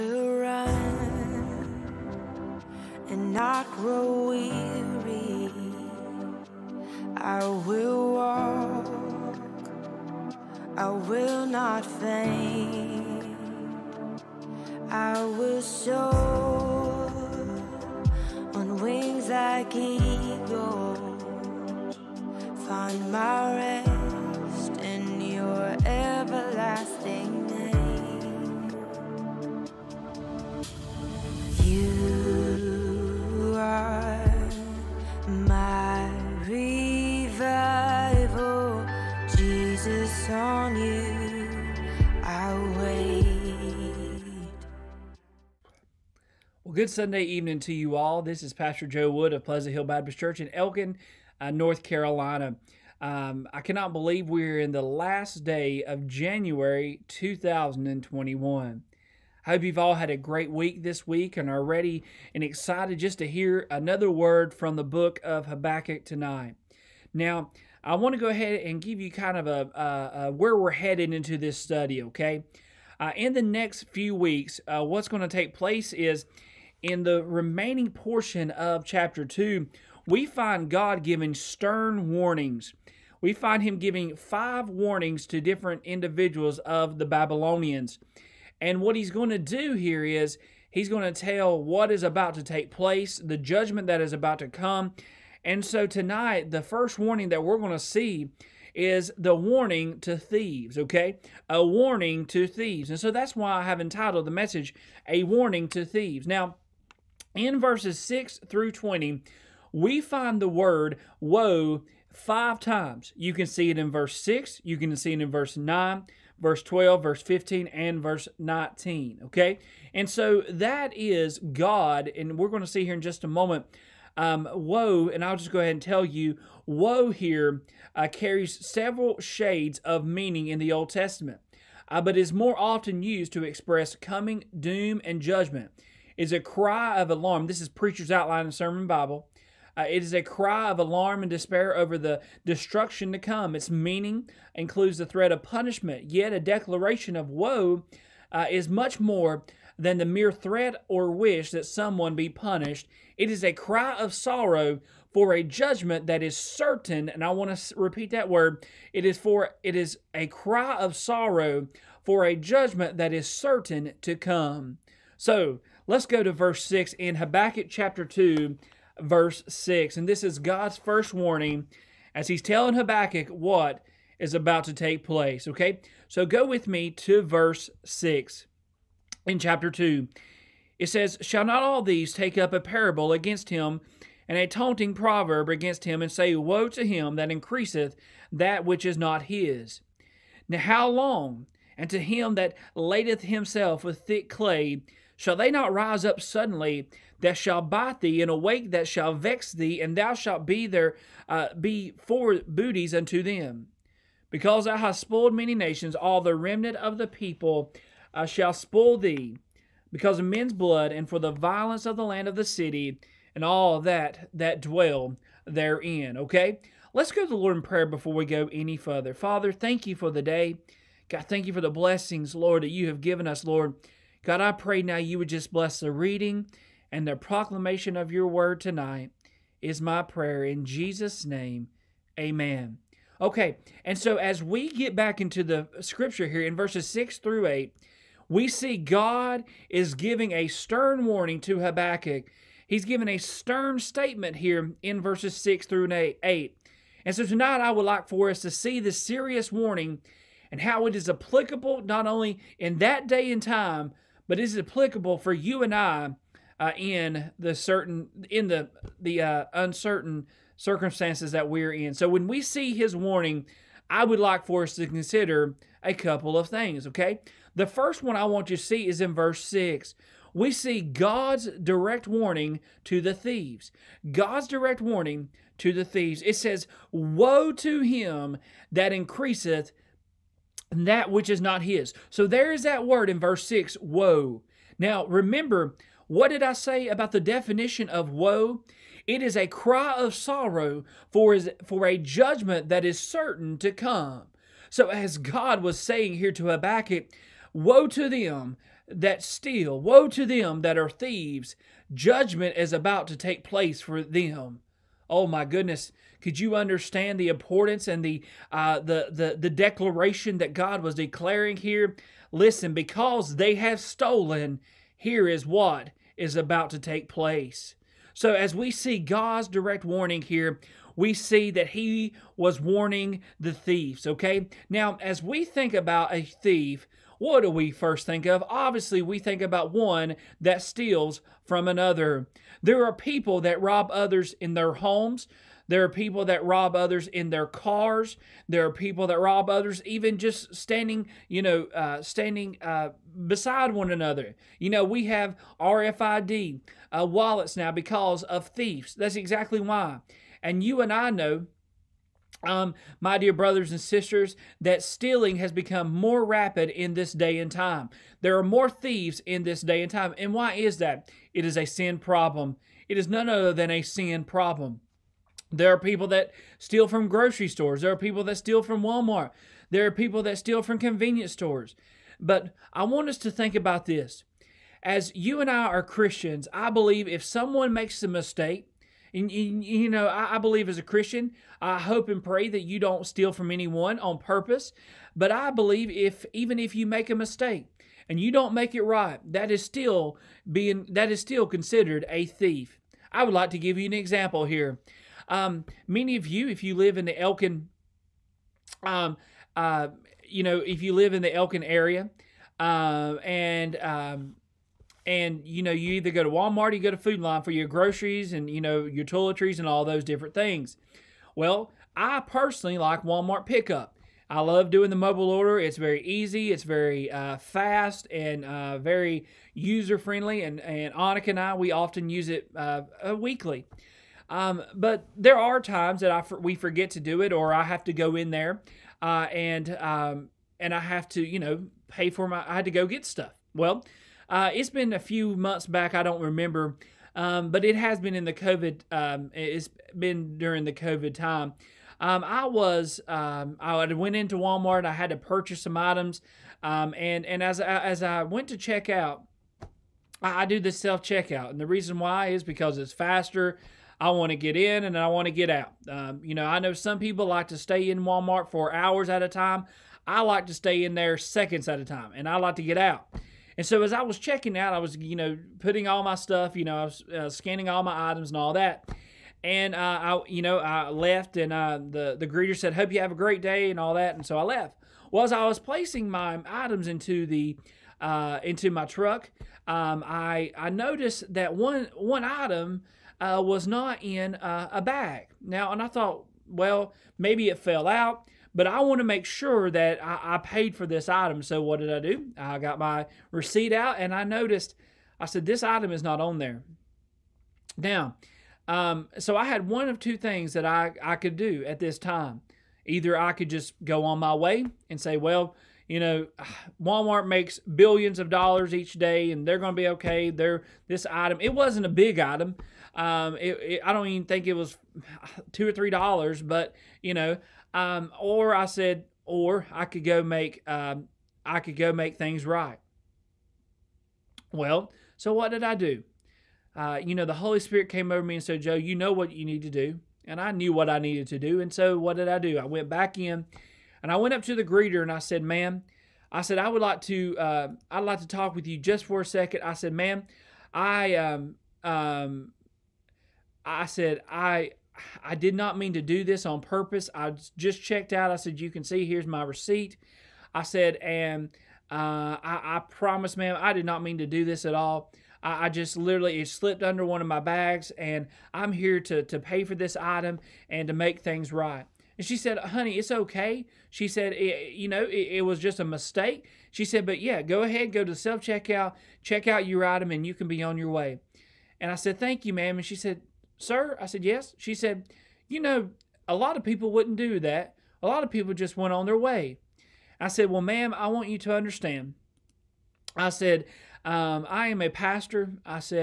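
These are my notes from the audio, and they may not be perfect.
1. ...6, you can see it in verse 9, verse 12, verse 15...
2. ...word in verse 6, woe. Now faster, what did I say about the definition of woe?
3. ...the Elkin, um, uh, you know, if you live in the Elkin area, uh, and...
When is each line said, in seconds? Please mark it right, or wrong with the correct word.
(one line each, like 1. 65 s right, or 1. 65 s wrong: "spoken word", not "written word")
1. 114 s right
2. 282 s wrong: "remember", not "faster"
3. 397 s right.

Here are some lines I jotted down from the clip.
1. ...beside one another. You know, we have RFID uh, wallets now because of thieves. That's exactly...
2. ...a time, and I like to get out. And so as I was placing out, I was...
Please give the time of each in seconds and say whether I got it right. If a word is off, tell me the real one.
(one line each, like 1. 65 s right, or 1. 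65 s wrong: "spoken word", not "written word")
1. 343 s right
2. 461 s wrong: "checking", not "placing".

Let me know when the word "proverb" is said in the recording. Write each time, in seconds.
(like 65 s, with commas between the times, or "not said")
184 s.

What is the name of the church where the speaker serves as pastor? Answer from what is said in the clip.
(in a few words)
Pleasant Hill Baptist Church.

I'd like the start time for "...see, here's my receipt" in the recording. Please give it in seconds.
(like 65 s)
548 s.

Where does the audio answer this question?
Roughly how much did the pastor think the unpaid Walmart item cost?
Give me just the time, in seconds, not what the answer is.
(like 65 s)
515 s.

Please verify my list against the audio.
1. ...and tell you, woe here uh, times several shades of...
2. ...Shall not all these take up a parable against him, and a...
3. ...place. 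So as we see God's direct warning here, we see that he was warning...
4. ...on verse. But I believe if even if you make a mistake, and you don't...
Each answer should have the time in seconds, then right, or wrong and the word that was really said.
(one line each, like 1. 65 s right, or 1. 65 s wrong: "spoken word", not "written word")
1. 125 s wrong: "carries", not "times"
2. 181 s right
3. 317 s right
4. 383 s wrong: "purpose", not "verse".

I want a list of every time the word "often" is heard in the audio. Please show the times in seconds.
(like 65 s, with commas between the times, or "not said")
132 s, 421 s.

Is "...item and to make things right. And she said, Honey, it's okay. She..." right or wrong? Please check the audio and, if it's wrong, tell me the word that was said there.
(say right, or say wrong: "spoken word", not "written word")
right.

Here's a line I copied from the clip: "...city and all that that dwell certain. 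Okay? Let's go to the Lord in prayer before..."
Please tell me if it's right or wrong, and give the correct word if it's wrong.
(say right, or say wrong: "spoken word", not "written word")
wrong: "therein", not "certain".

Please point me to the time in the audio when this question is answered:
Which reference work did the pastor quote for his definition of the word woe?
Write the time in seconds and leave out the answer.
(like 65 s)
137 s.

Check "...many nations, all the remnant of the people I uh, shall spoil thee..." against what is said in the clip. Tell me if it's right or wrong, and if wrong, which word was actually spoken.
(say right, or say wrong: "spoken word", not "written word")
right.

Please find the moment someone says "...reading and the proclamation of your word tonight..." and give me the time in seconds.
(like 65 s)
225 s.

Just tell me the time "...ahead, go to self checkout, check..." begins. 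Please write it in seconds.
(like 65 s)
567 s.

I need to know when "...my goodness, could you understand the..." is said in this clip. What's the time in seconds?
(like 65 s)
305 s.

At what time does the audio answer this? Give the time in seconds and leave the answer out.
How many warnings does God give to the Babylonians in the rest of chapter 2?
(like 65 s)
84 s.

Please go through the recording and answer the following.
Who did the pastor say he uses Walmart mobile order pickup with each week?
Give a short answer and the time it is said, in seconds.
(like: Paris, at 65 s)
Annika, at 420 s.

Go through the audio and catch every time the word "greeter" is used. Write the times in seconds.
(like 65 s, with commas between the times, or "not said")
472 s, 534 s.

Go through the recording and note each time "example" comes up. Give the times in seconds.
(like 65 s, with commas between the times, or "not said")
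393 s.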